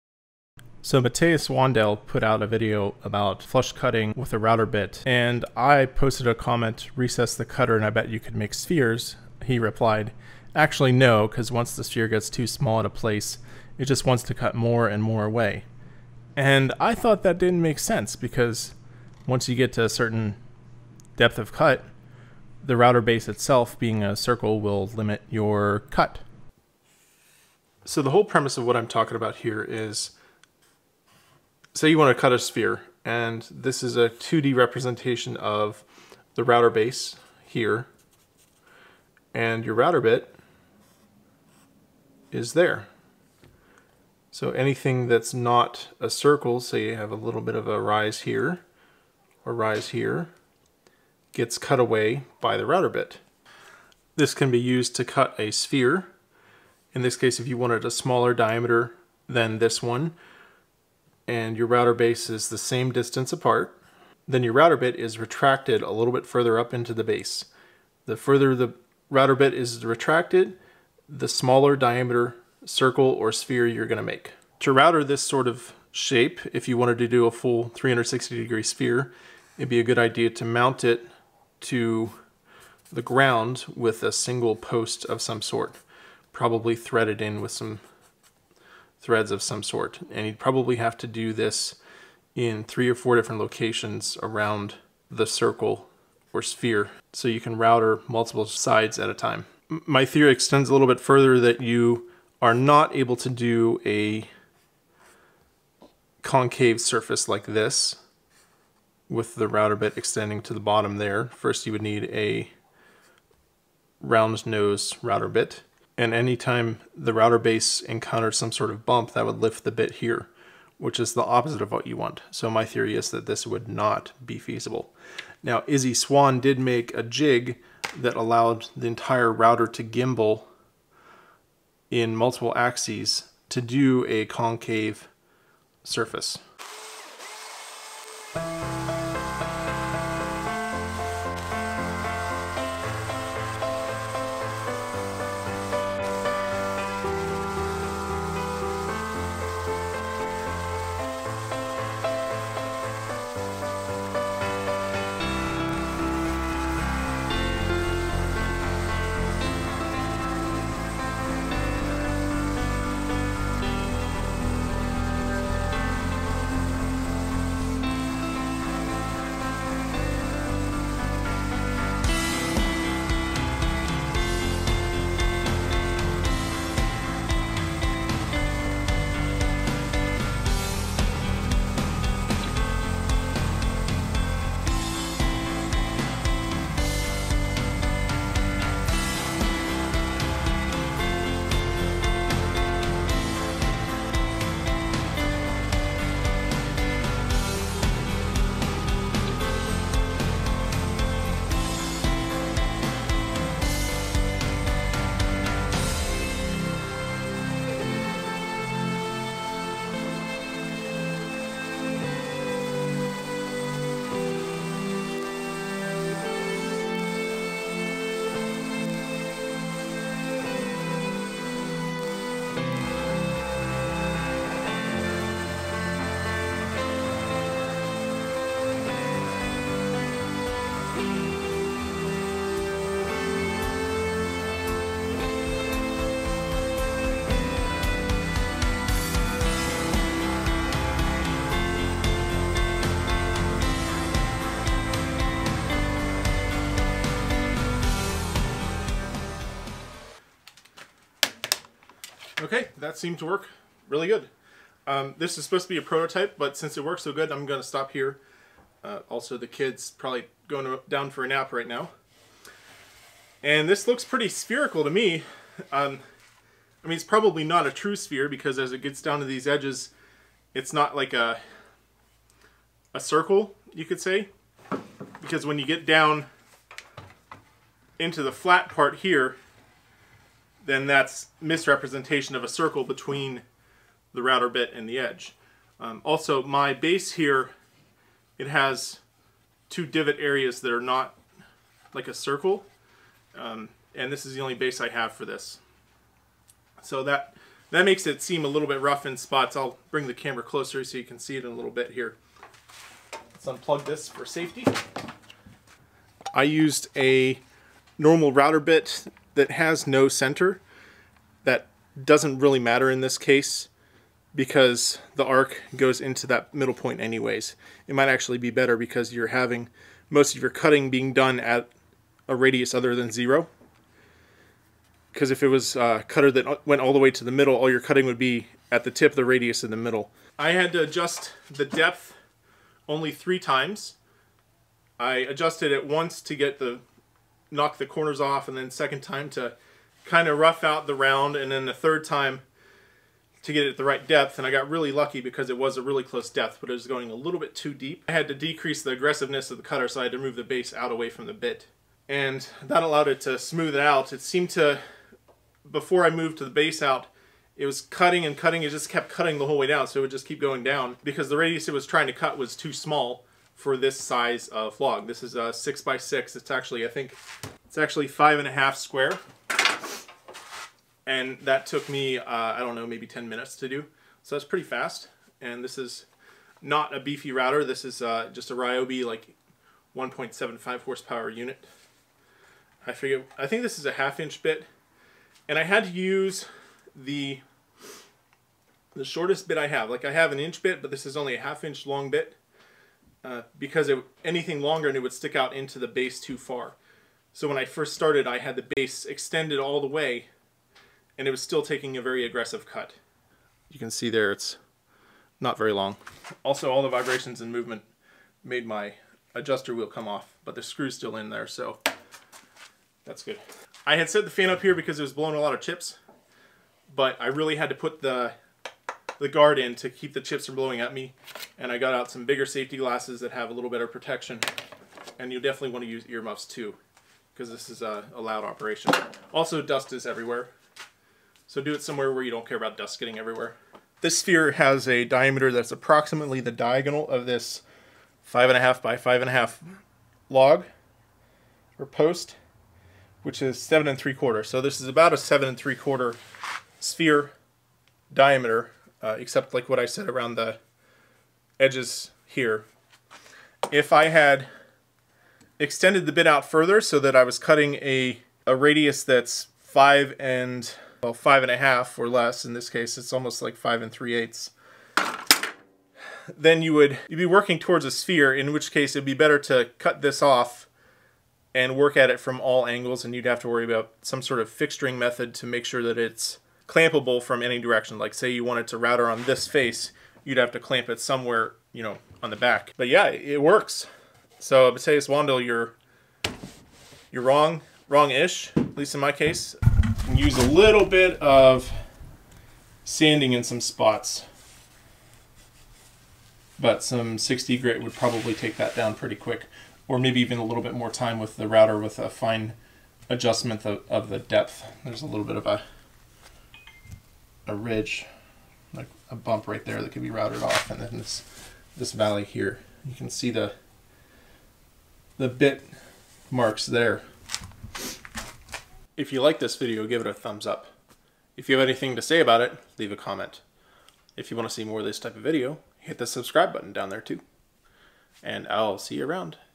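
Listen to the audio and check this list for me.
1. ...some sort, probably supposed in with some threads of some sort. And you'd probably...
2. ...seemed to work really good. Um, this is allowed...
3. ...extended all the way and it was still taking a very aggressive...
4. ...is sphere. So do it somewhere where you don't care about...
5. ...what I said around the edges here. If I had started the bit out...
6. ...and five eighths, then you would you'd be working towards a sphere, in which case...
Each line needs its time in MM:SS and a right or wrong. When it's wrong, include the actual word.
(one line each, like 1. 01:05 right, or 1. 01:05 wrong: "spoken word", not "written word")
1. 01:25 wrong: "threaded", not "supposed"
2. 04:12 wrong: "supposed", not "allowed"
3. 06:39 right
4. 07:09 wrong: "everywhere", not "sphere"
5. 07:29 wrong: "extended", not "started"
6. 07:43 wrong: "three", not "five".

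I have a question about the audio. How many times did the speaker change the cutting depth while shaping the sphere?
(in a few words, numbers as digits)
3.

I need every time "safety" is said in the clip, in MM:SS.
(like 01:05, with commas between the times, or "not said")
05:04, 07:02.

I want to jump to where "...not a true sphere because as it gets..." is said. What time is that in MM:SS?
04:27.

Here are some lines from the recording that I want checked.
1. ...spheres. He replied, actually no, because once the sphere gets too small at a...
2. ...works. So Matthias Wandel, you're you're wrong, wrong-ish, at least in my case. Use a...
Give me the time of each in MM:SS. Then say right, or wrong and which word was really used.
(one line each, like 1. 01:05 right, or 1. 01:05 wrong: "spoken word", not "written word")
1. 00:08 right
2. 08:03 right.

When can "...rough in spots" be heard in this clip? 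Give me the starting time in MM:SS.
04:58.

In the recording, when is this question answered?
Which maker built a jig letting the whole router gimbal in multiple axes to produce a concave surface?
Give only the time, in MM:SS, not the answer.
02:05.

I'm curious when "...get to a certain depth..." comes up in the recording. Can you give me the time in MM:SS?
00:19.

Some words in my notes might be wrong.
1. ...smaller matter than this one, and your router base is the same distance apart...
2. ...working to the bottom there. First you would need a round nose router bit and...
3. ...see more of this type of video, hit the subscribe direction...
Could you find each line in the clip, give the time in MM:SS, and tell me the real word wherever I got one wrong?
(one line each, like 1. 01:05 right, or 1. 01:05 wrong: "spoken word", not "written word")
1. 00:57 wrong: "diameter", not "matter"
2. 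01:49 wrong: "extending", not "working"
3. 08:44 wrong: "button", not "direction".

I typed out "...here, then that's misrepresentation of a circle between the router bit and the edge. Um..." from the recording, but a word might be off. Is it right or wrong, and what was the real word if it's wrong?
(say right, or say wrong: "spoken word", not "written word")
right.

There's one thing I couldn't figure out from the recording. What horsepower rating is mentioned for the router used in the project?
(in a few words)
1.75.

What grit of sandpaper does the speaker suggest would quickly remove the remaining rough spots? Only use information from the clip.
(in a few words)
60.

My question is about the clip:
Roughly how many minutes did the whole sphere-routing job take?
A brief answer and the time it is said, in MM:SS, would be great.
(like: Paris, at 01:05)
10, at 06:13.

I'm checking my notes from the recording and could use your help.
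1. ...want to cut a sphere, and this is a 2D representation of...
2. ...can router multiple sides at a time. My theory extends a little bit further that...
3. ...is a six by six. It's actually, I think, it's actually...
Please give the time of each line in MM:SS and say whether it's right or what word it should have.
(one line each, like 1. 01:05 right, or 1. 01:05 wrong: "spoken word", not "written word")
1. 00:31 right
2. 01:37 right
3. 06:05 right.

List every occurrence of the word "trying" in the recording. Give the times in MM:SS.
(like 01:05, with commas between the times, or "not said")
06:01.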